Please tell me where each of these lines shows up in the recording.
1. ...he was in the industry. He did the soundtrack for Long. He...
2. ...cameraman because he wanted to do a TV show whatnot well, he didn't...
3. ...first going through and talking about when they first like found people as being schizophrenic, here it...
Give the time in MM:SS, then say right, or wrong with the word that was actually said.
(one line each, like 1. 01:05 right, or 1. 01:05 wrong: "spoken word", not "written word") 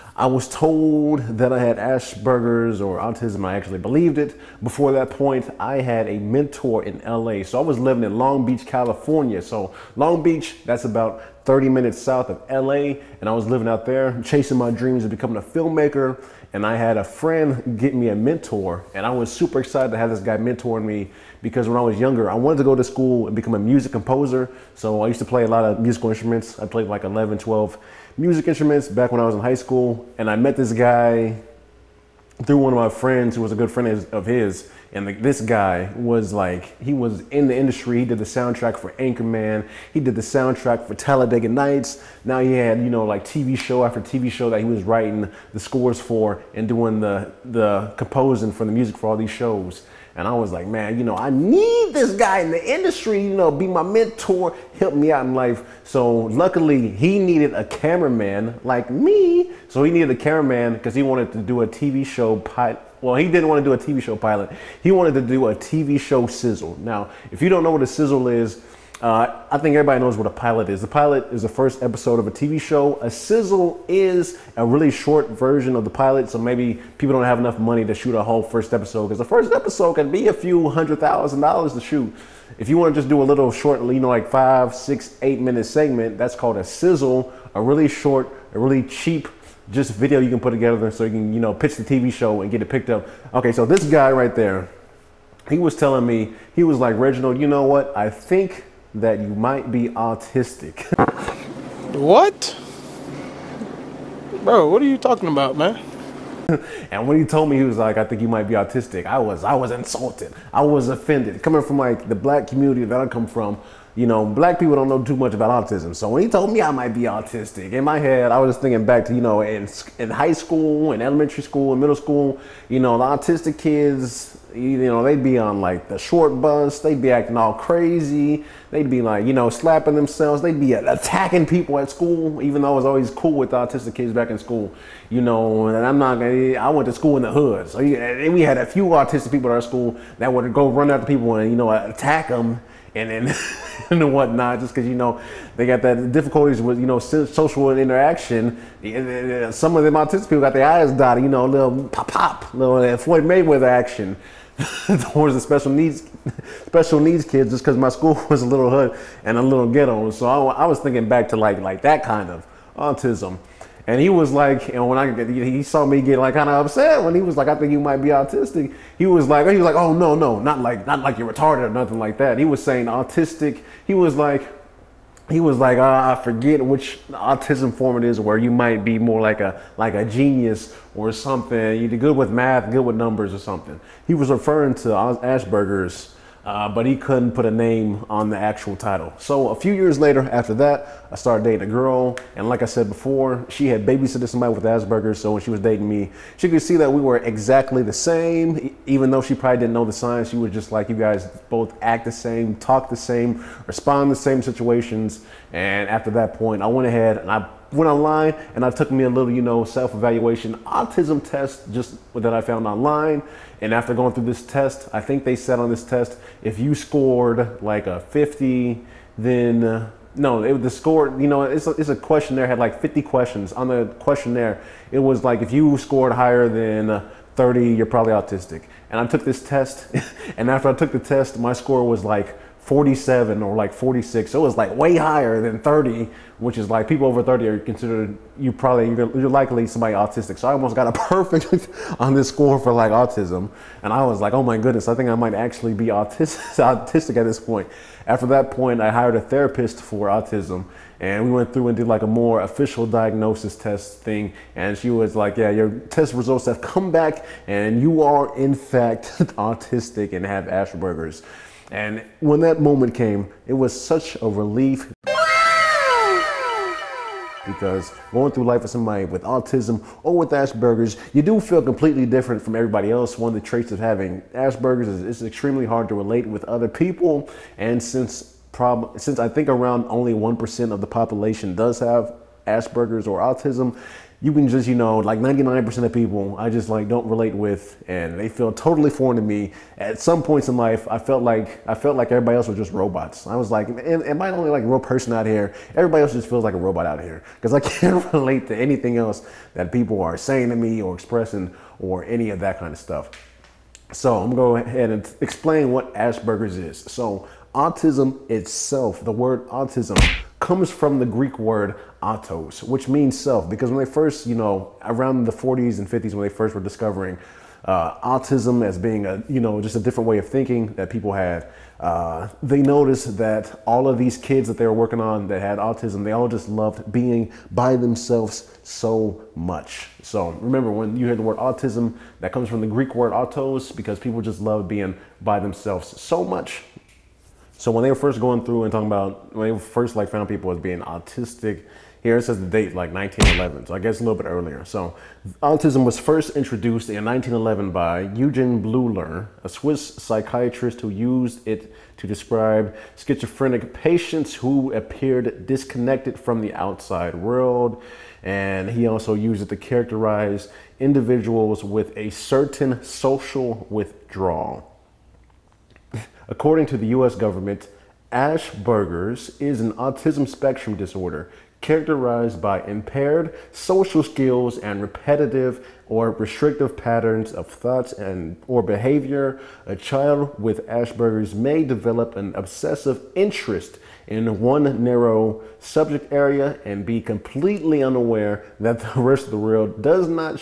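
1. 00:36 wrong: "Anchorman", not "Long"
2. 01:00 wrong: "pilot", not "whatnot"
3. 05:37 wrong: "autistic", not "schizophrenic".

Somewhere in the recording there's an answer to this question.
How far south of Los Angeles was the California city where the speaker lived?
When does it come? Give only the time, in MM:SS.
00:11.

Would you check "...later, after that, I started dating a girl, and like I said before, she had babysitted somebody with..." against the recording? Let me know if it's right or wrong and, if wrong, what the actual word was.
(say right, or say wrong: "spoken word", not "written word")
right.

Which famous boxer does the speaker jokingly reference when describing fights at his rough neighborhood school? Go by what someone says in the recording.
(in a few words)
Floyd Mayweather.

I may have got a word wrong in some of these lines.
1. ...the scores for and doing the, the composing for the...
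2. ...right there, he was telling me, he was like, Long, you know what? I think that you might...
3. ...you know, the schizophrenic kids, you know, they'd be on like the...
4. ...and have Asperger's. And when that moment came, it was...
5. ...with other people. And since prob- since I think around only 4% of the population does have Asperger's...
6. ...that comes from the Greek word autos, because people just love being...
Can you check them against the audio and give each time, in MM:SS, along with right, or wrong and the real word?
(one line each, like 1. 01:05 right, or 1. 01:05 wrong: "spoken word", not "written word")
1. 00:45 right
2. 01:34 wrong: "Reginald", not "Long"
3. 02:02 wrong: "autistic", not "schizophrenic"
4. 04:20 right
5. 04:36 wrong: "1", not "4"
6. 05:32 right.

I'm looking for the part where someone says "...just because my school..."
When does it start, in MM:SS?
02:37.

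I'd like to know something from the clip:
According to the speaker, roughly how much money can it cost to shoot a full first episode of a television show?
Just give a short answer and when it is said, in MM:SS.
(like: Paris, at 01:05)
a few hundred thousand dollars, at 01:20.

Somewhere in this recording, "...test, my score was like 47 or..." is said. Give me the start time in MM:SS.
03:51.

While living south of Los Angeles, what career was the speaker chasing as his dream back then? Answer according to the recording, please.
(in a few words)
filmmaker.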